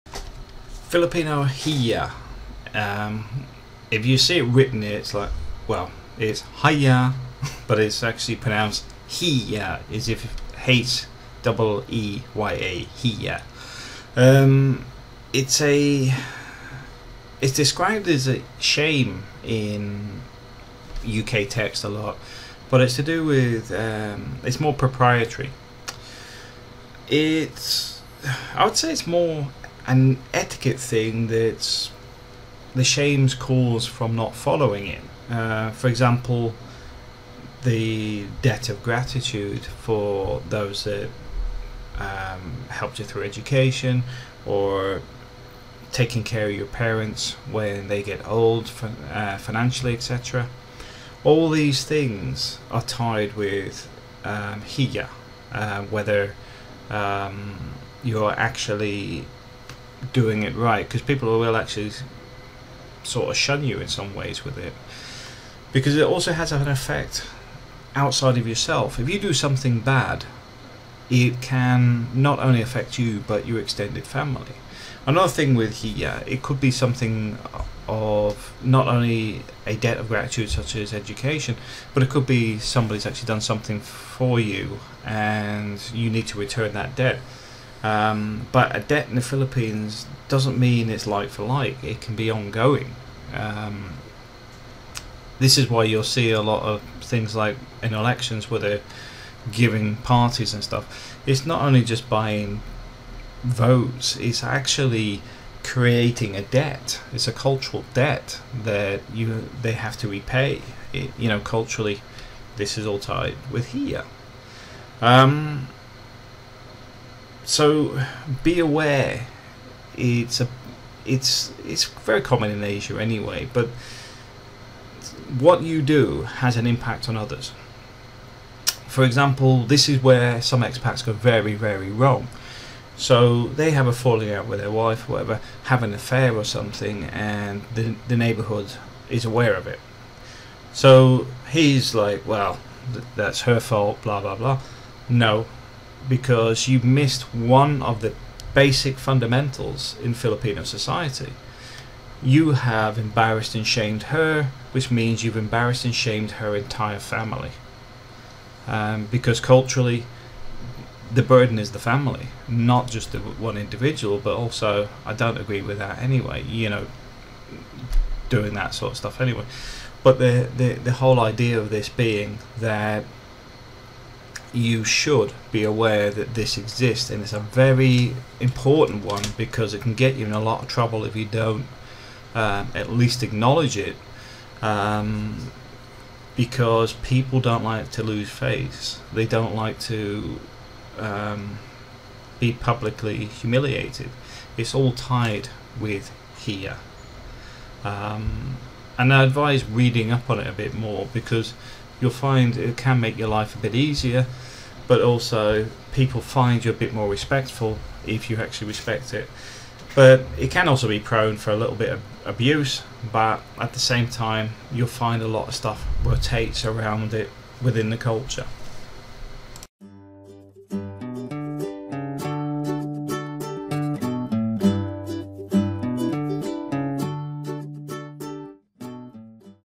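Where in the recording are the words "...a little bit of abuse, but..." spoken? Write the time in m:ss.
3:31.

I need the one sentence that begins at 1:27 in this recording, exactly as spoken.
Um, but a debt in the Philippines doesn't mean it's like for like.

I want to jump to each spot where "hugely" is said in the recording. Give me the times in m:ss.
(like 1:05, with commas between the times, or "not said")
not said.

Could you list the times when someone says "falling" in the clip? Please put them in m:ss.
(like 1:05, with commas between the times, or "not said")
2:13.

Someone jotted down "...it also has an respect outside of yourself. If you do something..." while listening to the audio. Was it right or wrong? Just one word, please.
wrong.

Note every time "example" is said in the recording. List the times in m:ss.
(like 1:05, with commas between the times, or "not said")
0:35, 2:09.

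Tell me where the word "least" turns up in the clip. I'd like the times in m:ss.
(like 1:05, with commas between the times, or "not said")
3:02.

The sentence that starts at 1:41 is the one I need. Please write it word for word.
It's not only just buying votes, it's actually creating a debt.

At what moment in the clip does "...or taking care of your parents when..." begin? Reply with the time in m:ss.
0:44.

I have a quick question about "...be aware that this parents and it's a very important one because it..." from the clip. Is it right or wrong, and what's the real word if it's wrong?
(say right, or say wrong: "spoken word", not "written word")
wrong: "exists", not "parents".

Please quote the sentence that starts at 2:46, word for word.
You know, doing that sort of stuff anyway.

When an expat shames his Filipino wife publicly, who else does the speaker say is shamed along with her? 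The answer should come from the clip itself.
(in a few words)
her entire family.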